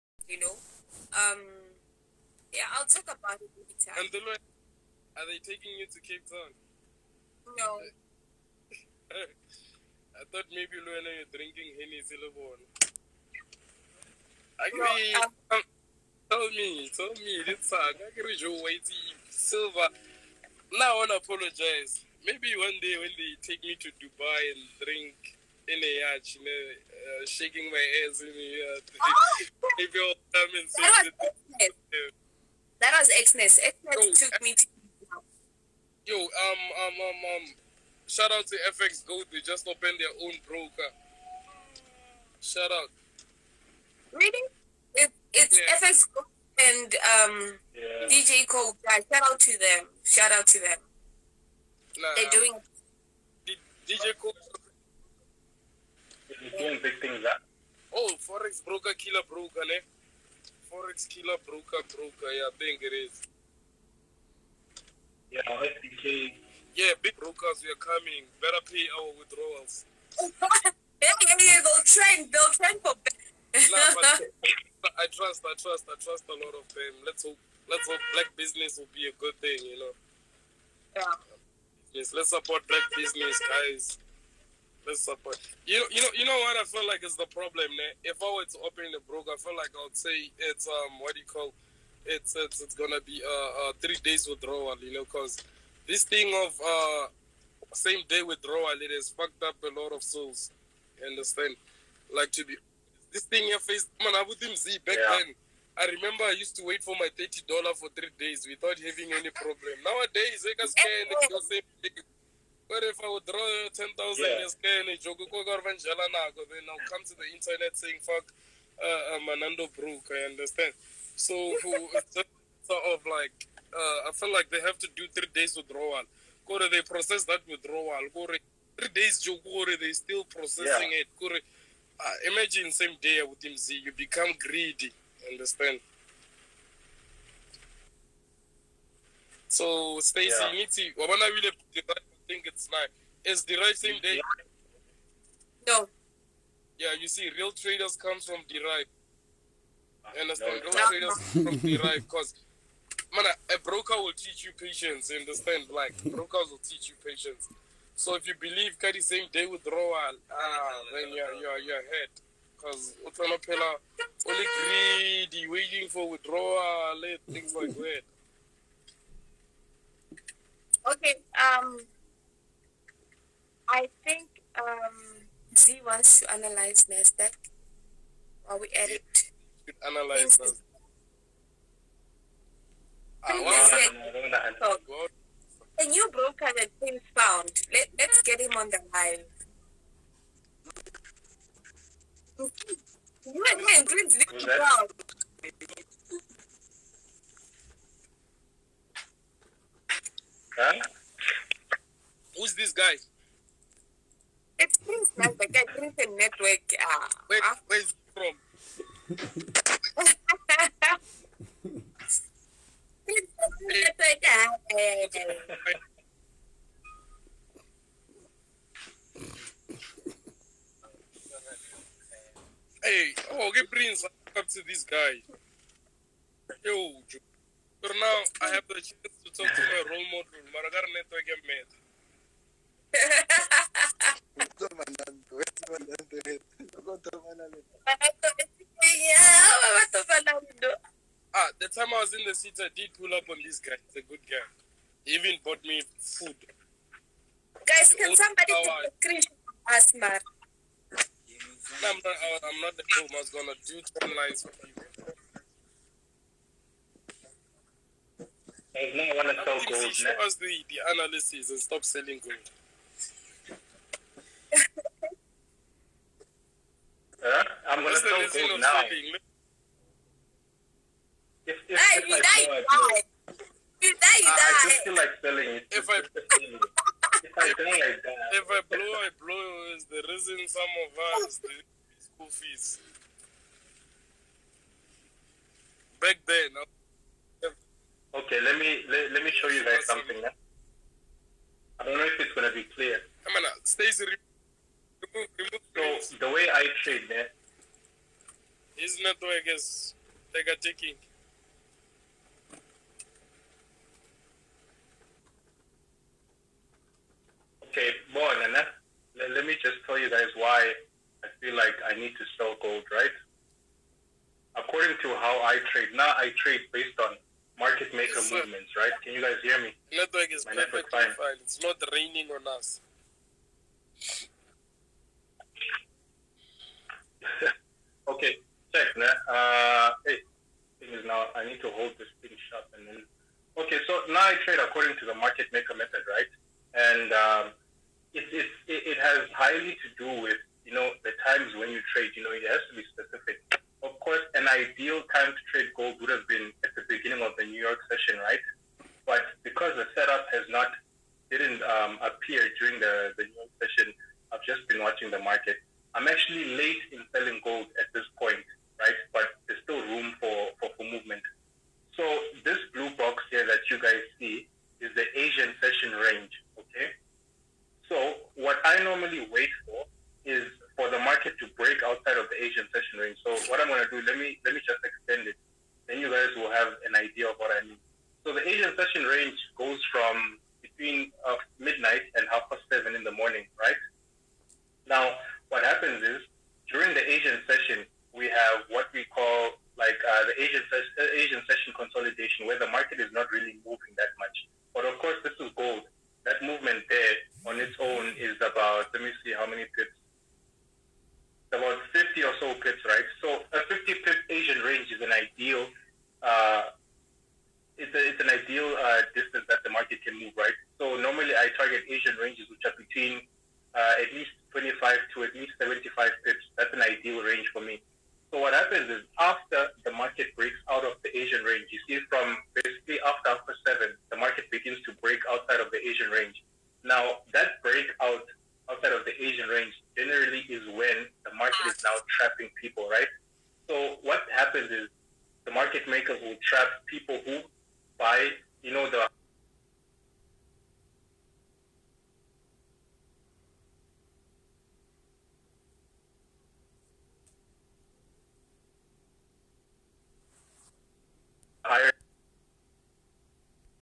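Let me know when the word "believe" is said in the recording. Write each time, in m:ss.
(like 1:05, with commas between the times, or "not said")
2:38.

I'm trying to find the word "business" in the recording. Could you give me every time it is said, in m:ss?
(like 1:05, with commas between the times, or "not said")
1:18, 1:22.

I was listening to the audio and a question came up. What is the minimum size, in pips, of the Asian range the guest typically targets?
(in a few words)
25 pips.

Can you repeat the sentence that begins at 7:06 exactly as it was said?
Now that breakout outside of the Asian range generally is when the market is now trapping people, right?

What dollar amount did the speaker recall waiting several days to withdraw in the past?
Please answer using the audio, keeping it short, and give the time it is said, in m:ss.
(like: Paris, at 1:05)
$30, at 1:47.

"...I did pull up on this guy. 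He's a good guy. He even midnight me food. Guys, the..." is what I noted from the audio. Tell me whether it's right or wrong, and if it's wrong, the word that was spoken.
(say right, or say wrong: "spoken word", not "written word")
wrong: "bought", not "midnight".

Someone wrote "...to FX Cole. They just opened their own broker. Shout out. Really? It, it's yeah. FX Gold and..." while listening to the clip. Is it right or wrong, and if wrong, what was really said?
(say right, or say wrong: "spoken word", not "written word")
wrong: "Gold", not "Cole".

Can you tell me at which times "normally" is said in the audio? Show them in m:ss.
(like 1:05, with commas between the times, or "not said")
6:08, 6:50.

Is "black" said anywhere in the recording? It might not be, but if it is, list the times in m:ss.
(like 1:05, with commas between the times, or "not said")
1:18, 1:22.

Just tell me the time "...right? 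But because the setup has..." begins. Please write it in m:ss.
5:48.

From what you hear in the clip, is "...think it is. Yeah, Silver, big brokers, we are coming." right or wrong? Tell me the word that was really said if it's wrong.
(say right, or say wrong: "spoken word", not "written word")
wrong: "Yeah", not "Silver".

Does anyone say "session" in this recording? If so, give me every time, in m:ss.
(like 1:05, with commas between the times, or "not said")
5:47, 5:53, 6:05, 6:12, 6:18, 6:27, 6:31.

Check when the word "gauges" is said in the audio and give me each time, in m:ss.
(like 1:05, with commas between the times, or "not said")
not said.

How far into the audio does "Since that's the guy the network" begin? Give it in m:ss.
3:25.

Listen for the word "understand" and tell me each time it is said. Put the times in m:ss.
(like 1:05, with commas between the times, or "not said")
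1:41, 2:00, 2:15, 2:30, 2:35.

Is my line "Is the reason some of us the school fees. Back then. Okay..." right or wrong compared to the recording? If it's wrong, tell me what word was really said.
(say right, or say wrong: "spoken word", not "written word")
right.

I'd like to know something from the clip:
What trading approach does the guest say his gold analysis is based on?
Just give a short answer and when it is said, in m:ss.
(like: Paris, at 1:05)
Market maker method, at 5:35.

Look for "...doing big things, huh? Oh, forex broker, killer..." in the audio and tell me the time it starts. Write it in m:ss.
0:56.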